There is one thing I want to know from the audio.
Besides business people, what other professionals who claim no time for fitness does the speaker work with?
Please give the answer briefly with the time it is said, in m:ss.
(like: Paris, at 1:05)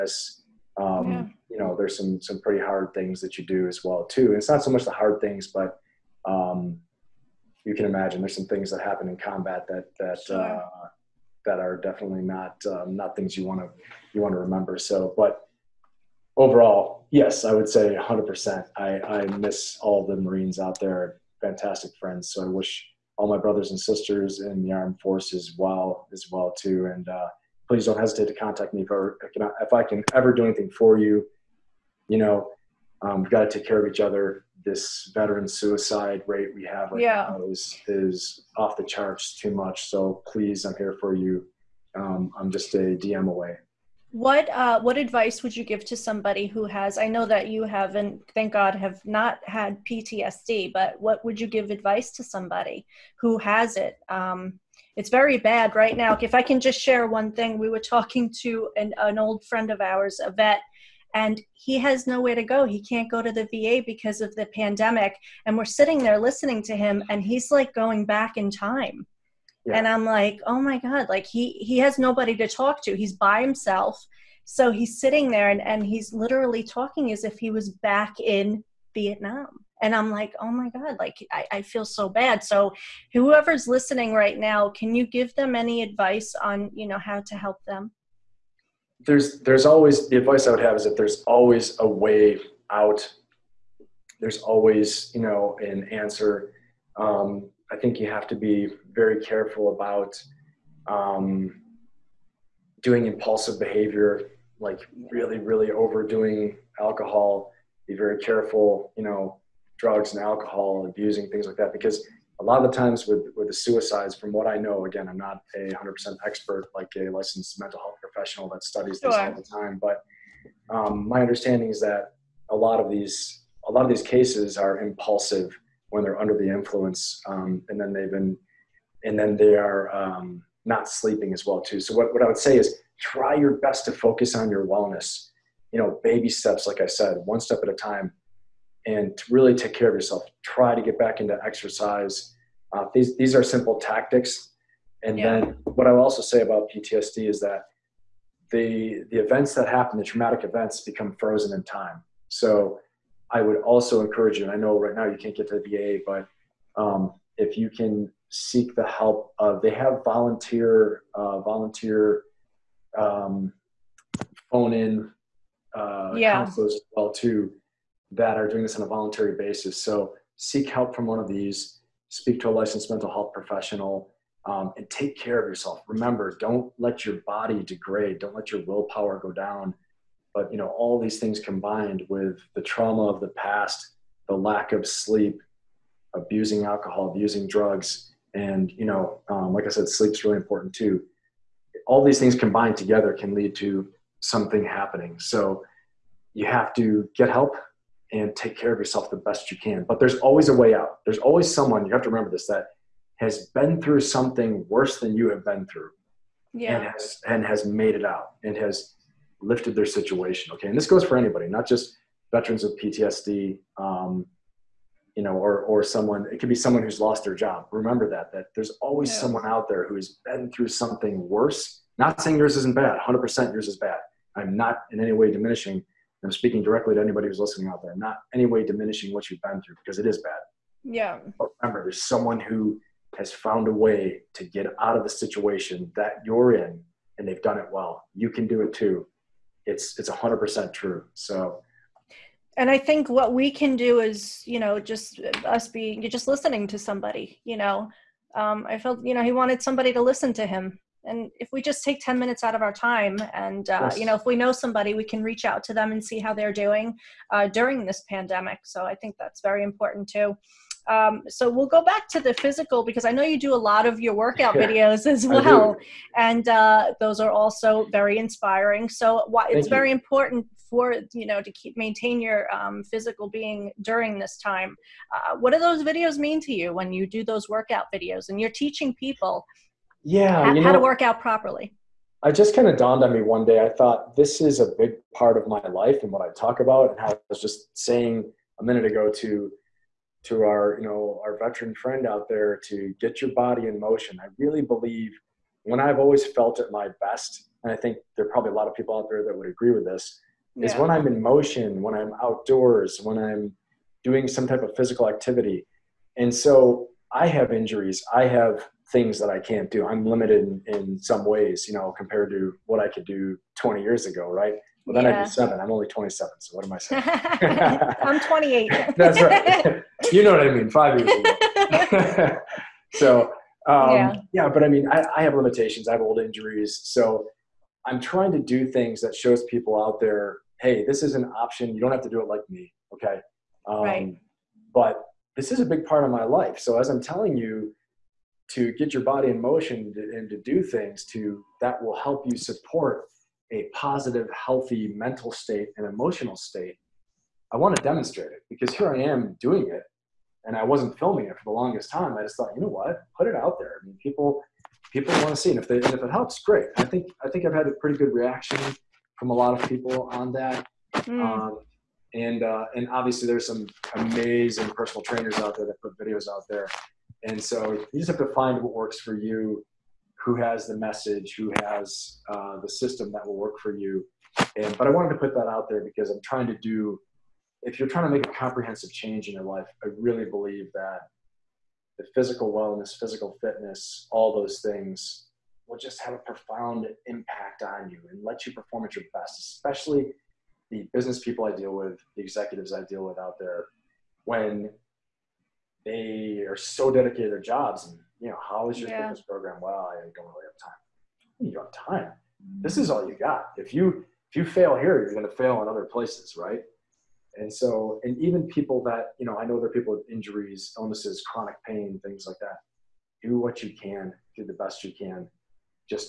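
executives, at 6:32.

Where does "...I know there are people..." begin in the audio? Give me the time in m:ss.
6:49.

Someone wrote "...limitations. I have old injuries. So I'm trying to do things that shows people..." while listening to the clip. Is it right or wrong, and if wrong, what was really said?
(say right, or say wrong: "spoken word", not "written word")
right.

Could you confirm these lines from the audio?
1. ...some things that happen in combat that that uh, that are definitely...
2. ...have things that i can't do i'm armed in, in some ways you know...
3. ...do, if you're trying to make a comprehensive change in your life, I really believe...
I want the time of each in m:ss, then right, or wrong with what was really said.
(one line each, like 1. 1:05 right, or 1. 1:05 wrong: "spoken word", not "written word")
1. 0:08 right
2. 5:08 wrong: "limited", not "armed"
3. 6:16 right.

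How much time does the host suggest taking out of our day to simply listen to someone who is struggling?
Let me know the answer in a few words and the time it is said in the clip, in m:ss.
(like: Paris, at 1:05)
10 minutes, at 4:12.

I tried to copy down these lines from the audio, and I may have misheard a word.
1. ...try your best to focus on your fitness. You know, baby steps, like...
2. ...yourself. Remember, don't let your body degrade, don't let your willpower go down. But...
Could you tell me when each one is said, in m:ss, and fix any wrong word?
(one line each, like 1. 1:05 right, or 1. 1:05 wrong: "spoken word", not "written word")
1. 2:12 wrong: "wellness", not "fitness"
2. 2:55 right.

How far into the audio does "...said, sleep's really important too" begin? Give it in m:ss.
3:09.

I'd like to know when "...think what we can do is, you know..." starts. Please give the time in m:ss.
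4:02.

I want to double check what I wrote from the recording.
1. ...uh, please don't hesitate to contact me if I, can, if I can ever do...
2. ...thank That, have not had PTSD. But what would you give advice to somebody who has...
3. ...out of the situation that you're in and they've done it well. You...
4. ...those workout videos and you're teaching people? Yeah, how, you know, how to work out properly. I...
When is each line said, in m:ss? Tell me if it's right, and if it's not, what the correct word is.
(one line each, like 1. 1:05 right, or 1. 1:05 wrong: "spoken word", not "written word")
1. 0:27 right
2. 0:48 wrong: "God", not "That"
3. 3:54 right
4. 4:37 right.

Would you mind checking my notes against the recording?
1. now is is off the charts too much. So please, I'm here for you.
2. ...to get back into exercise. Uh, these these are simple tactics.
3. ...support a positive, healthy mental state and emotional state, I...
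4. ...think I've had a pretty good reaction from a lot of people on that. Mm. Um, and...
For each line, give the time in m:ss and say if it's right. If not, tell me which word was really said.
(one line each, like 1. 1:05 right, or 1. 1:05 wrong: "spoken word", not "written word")
1. 0:37 right
2. 2:20 right
3. 5:42 right
4. 5:57 right.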